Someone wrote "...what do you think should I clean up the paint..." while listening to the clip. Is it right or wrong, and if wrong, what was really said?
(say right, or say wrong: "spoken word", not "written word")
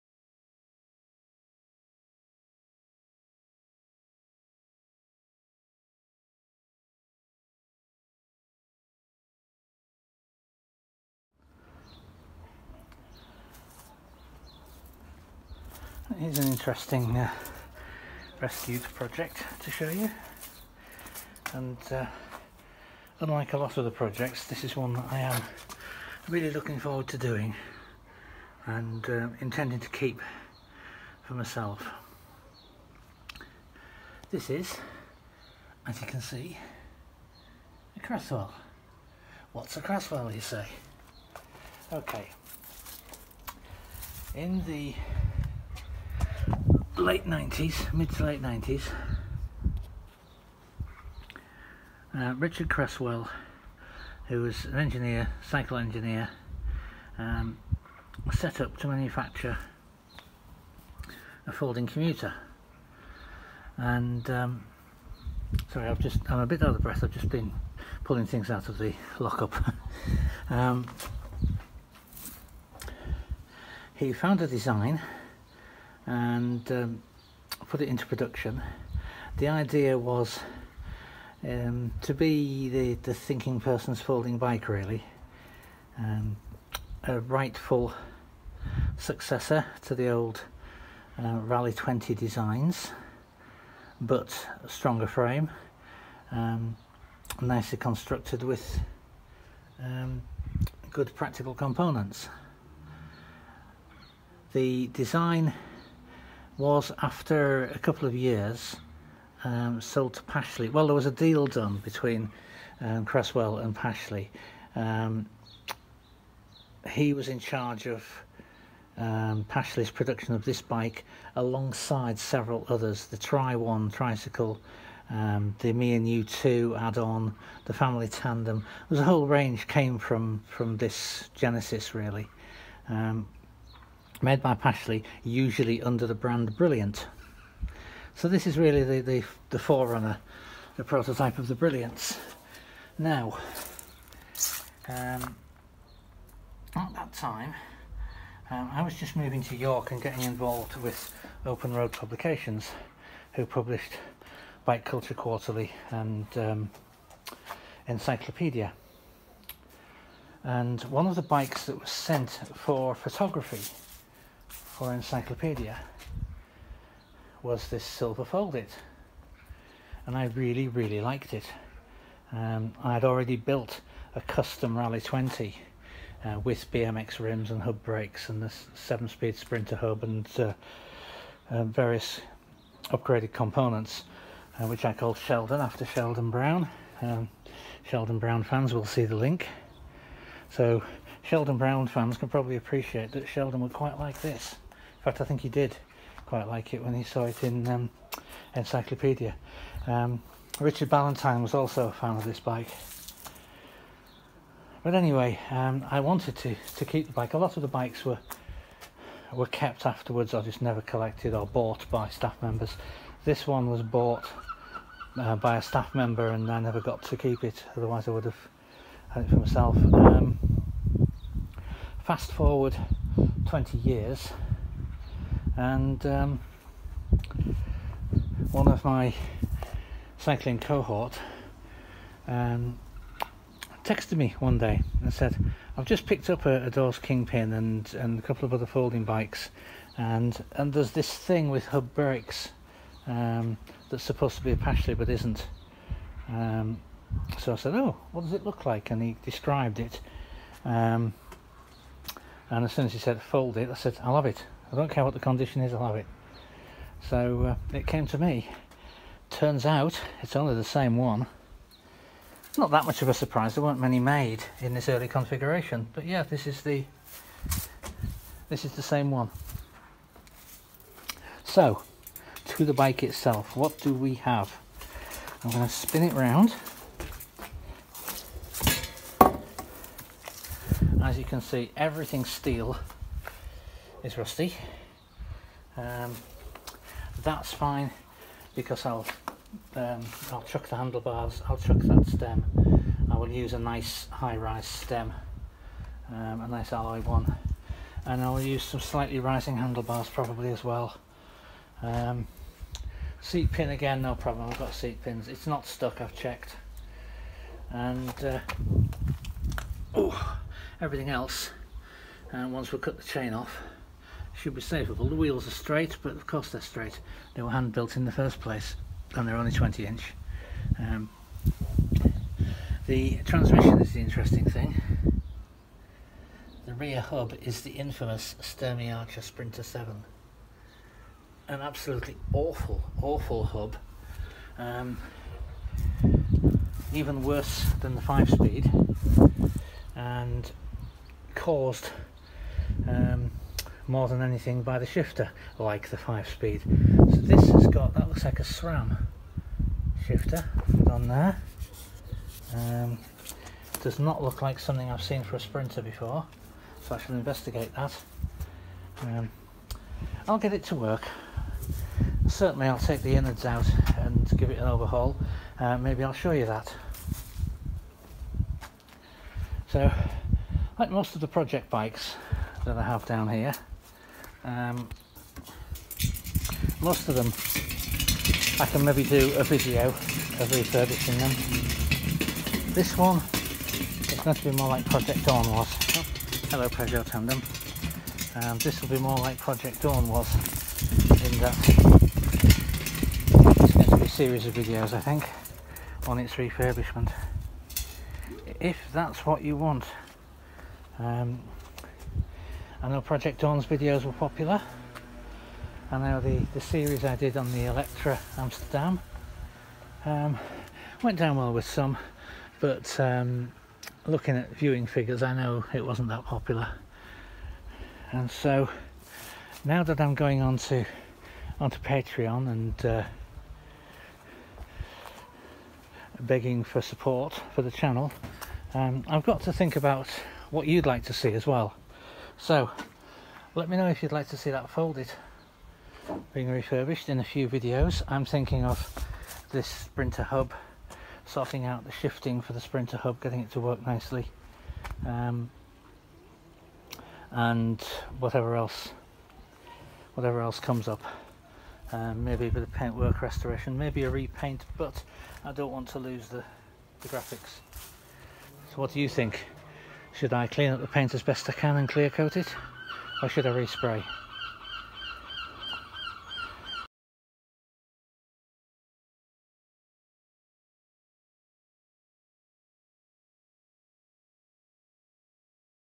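right.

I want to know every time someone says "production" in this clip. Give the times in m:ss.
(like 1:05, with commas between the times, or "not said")
1:18, 1:59.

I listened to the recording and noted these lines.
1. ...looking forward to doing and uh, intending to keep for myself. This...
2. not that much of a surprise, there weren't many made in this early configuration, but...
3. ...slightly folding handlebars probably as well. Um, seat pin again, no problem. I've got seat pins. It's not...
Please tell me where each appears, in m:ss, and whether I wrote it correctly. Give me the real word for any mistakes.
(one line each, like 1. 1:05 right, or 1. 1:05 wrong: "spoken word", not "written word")
1. 0:26 right
2. 4:22 right
3. 4:58 wrong: "rising", not "folding".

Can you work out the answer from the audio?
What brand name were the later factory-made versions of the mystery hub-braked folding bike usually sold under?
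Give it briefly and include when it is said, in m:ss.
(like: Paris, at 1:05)
Brilliant, at 2:16.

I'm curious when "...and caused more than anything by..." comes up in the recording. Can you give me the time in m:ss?
5:39.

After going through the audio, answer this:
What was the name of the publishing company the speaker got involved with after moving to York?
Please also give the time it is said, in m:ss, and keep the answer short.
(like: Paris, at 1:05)
Open Road Publications, at 2:31.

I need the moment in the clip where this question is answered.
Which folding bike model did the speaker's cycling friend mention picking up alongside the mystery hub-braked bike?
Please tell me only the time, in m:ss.
3:56.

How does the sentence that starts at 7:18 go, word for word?
I'm thinking of this Sprinter hub, sorting out the shifting for the Sprinter hub, getting it to work nicely.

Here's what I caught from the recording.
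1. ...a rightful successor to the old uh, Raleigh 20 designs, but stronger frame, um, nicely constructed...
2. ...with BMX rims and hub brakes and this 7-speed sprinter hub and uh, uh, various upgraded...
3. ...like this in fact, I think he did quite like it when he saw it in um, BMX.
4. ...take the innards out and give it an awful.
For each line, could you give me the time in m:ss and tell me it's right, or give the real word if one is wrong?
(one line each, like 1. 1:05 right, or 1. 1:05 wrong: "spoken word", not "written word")
1. 1:27 right
2. 2:56 right
3. 3:13 wrong: "Encycleopedia", not "BMX"
4. 6:02 wrong: "overhaul", not "awful".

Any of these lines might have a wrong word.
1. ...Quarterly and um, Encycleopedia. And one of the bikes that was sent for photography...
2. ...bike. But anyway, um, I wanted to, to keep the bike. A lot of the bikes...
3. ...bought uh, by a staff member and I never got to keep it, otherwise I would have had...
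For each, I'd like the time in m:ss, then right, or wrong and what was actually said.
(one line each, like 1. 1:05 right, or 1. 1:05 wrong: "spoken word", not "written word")
1. 2:35 right
2. 3:22 right
3. 3:33 right.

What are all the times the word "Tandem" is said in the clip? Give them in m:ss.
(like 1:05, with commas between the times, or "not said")
2:08, 6:27.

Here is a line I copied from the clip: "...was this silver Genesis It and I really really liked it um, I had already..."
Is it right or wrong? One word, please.
wrong.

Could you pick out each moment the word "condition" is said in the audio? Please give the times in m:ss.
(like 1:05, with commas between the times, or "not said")
4:15.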